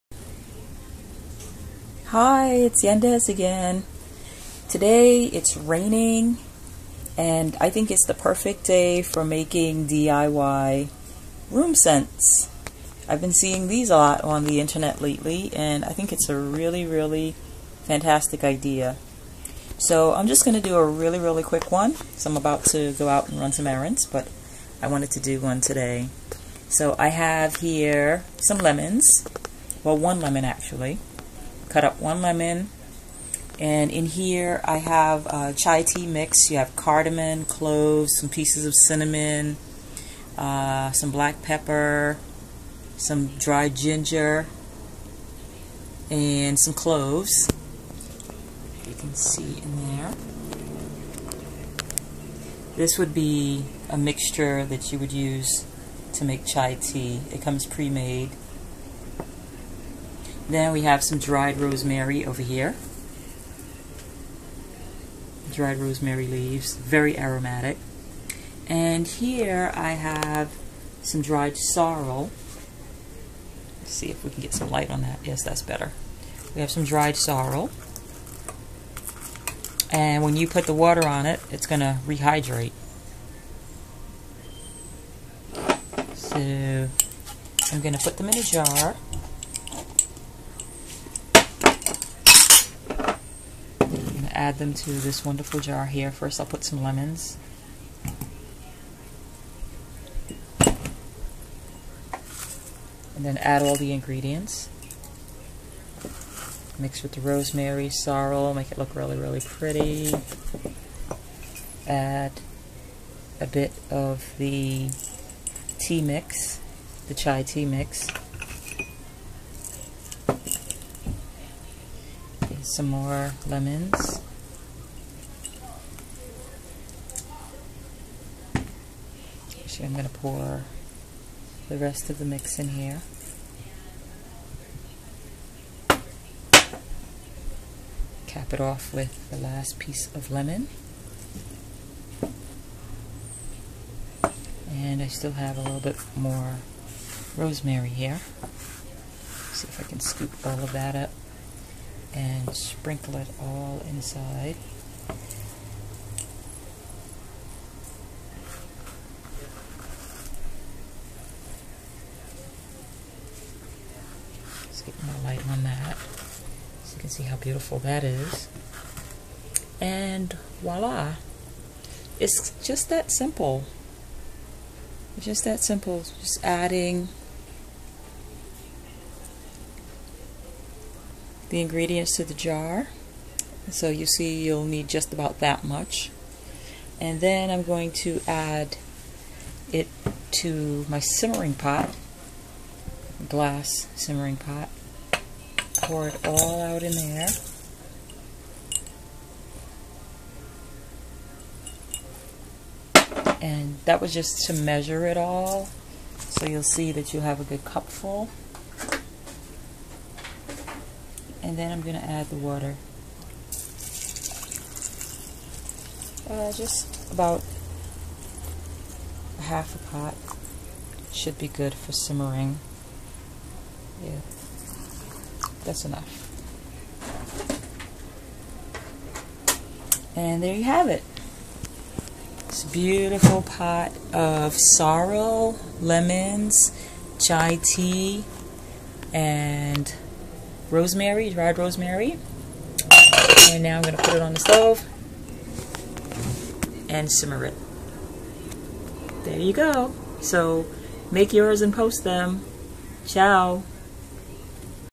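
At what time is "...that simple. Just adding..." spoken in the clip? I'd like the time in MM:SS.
02:55.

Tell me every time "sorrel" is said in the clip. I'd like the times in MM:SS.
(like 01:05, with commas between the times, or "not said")
01:11, 01:17, 01:47, 03:54.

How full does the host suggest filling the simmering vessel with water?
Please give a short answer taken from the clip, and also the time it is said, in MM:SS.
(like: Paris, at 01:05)
Half a pot, at 03:39.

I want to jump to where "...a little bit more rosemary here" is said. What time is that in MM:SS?
02:25.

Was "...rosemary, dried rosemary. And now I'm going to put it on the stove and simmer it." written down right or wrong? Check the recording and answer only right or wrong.
right.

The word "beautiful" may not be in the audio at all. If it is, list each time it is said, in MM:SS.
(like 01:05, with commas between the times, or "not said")
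02:47, 03:52.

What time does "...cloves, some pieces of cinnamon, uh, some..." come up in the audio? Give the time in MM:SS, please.
00:37.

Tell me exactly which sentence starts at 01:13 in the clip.
Let's see if we can get some light on that.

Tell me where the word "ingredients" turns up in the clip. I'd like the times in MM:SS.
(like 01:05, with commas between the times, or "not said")
01:43, 03:01.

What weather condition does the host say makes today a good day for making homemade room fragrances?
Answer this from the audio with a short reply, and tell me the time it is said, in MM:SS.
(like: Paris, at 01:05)
Raining, at 00:05.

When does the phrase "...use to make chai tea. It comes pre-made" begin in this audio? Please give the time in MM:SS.
00:55.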